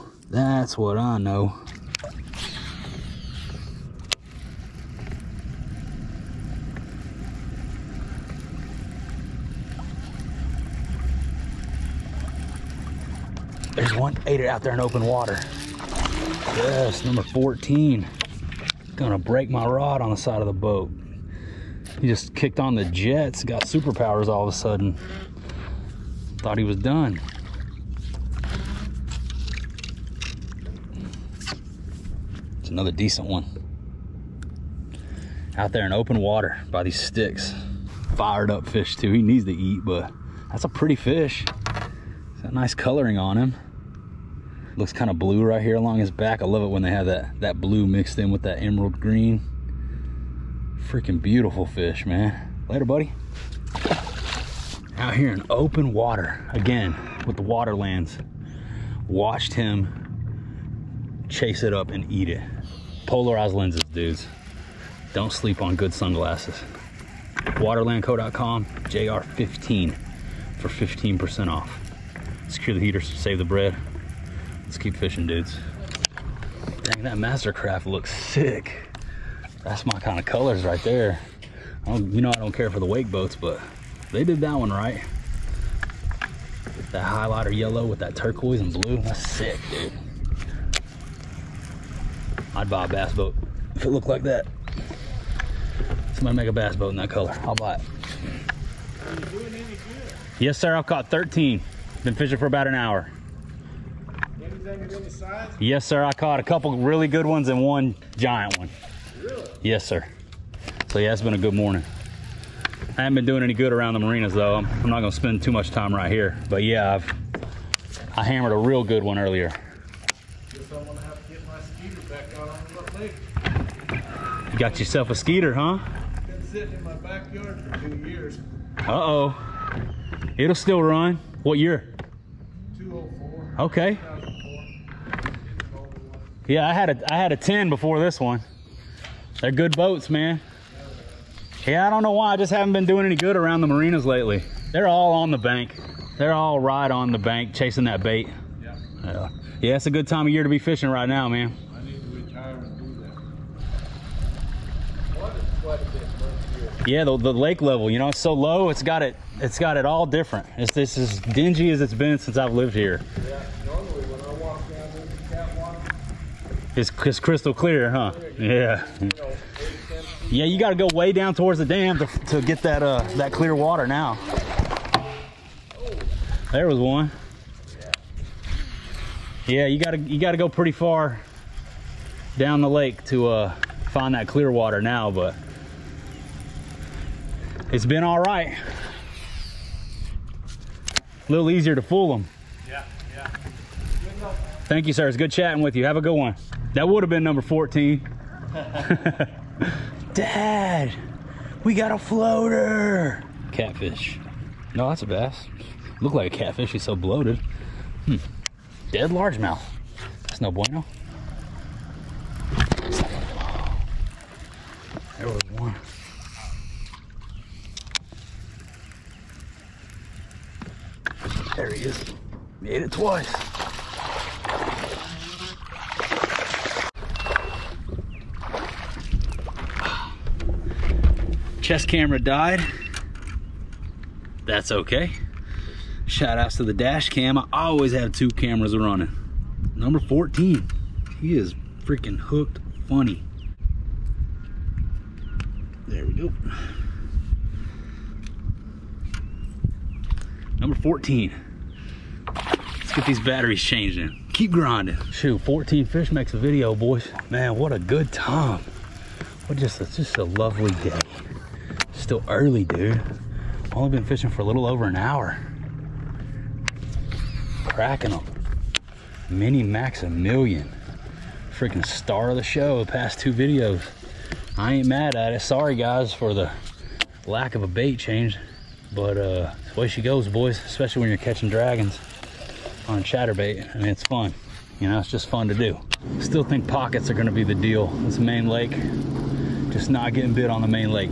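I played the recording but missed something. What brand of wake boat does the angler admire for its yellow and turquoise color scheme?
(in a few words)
Mastercraft.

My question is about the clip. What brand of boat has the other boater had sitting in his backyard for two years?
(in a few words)
Skeeter.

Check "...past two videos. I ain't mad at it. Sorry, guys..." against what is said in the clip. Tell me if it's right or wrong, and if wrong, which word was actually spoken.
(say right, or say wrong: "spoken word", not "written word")
right.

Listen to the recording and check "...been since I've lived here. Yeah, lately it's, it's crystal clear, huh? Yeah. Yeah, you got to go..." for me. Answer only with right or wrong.
wrong.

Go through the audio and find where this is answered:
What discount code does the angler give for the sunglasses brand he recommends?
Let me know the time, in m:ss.
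1:08.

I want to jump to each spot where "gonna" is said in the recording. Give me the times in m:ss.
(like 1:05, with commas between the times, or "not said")
0:18, 1:54, 4:47.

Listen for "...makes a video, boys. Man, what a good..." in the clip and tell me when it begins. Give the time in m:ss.
4:16.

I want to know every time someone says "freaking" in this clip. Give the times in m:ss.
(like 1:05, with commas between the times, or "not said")
0:50, 4:01, 4:31.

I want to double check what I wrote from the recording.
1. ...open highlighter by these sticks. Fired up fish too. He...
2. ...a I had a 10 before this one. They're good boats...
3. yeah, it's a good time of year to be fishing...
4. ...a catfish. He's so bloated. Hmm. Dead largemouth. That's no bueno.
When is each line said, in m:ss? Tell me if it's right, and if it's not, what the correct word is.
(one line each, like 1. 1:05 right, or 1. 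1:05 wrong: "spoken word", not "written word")
1. 0:35 wrong: "water", not "highlighter"
2. 2:16 right
3. 2:29 right
4. 3:26 right.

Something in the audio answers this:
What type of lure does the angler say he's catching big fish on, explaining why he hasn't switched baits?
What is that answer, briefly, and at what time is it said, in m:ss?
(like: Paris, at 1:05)
chatterbait, at 4:43.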